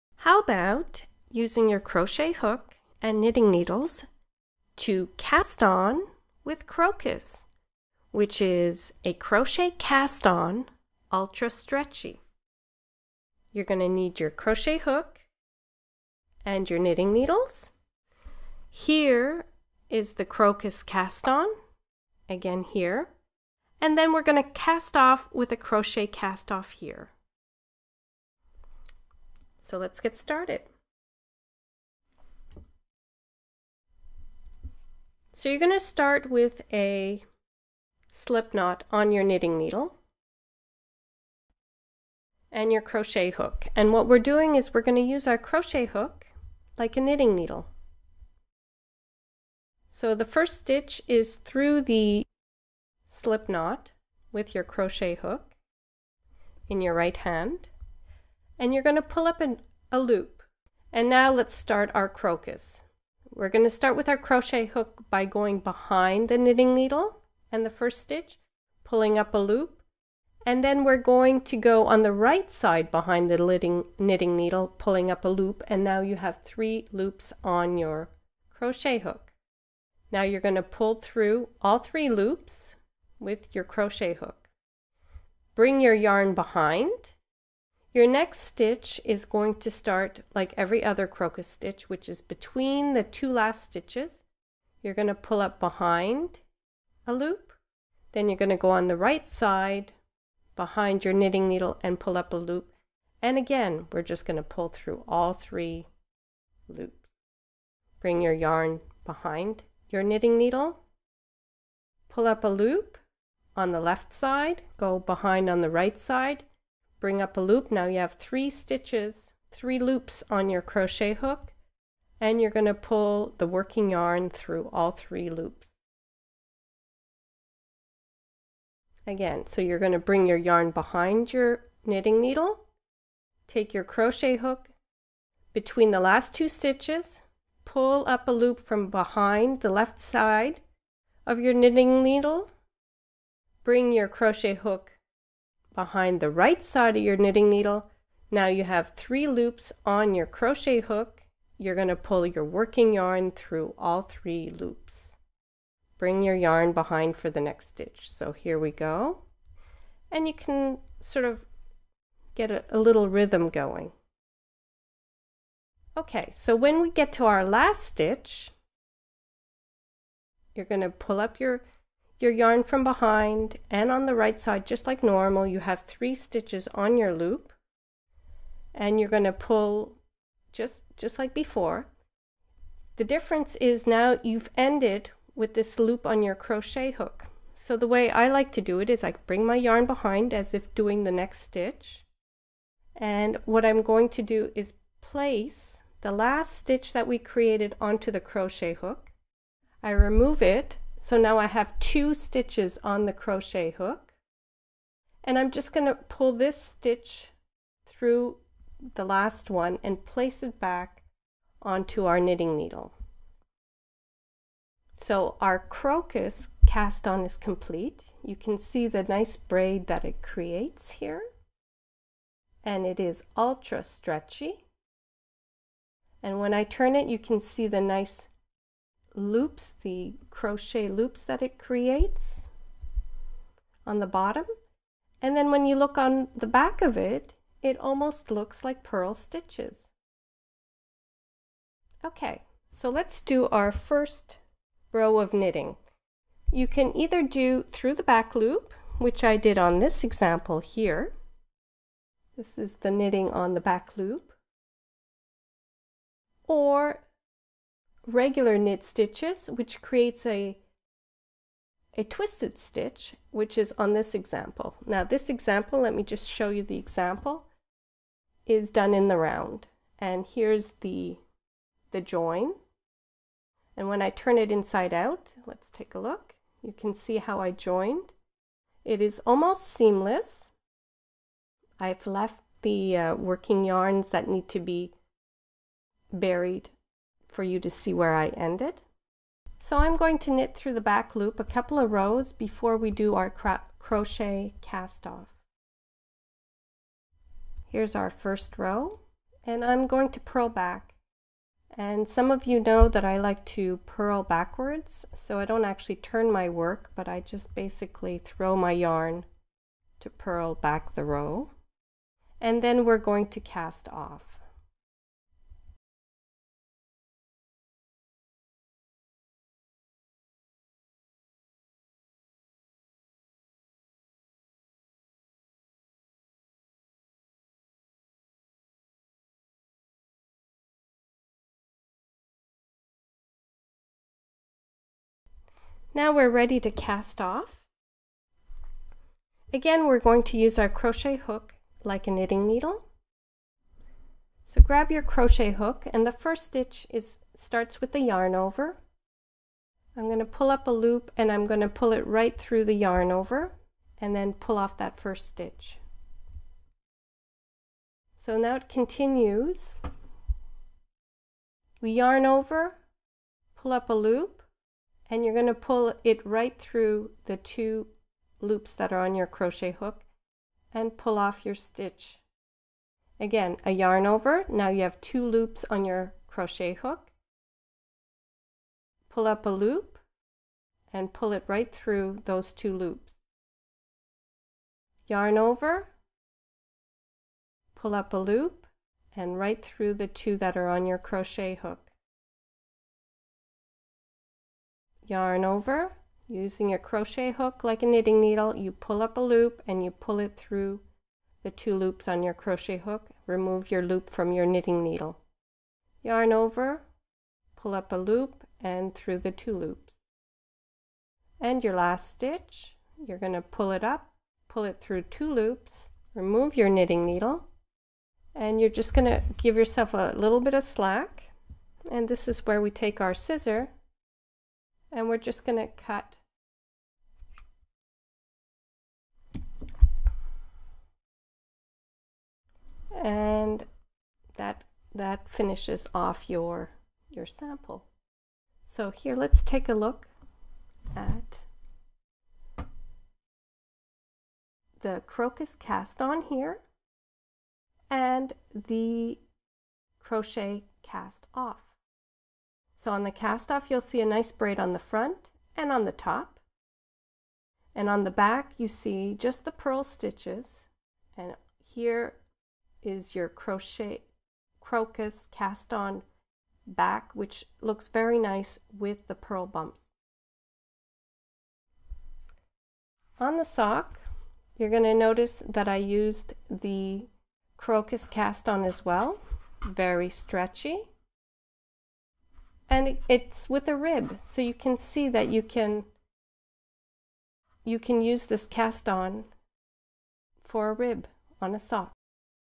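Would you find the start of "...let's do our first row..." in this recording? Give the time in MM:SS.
04:02.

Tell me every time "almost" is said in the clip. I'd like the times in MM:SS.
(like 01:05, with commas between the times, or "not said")
03:57, 04:39.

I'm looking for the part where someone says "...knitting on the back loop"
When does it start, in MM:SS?
04:12.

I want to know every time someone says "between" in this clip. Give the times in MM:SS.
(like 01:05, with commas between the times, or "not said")
01:32, 02:15.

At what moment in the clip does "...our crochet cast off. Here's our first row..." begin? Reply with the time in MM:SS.
04:53.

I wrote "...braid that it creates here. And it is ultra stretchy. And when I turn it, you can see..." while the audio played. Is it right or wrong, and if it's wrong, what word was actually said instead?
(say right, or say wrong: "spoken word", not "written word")
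right.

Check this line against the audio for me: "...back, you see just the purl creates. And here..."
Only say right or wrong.
wrong.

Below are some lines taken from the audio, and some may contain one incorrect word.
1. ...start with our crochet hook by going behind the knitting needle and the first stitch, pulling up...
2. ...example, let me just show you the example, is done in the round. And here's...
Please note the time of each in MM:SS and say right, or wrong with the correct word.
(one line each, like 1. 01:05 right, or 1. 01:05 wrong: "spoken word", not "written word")
1. 01:03 right
2. 04:25 right.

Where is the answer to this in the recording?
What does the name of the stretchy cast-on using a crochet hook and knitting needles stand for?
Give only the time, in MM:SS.
00:09.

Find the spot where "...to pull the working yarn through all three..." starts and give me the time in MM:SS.
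02:02.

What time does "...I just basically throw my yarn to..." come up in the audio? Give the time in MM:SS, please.
05:07.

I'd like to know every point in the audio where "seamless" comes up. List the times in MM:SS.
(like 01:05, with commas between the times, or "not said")
04:39.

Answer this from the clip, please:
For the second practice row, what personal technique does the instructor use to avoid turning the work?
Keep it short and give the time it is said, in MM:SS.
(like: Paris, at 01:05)
purl backwards, at 05:03.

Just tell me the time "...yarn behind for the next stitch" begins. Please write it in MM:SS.
02:36.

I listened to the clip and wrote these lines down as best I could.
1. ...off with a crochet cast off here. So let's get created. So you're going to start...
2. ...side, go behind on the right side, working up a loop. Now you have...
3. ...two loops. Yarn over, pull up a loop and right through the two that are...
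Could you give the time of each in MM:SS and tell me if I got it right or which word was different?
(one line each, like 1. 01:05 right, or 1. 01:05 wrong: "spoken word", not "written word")
1. 00:24 wrong: "started", not "created"
2. 01:54 wrong: "bring", not "working"
3. 06:22 right.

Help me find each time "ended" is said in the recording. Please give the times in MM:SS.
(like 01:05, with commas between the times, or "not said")
03:04, 04:48.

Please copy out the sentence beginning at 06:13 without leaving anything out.
Again, a yarn over, now you have two loops on your crochet hook.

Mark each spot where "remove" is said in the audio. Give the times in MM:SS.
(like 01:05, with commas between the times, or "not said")
03:19, 06:43, 06:56.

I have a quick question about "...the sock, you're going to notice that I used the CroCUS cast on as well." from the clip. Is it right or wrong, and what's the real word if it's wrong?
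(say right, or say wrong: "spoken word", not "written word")
right.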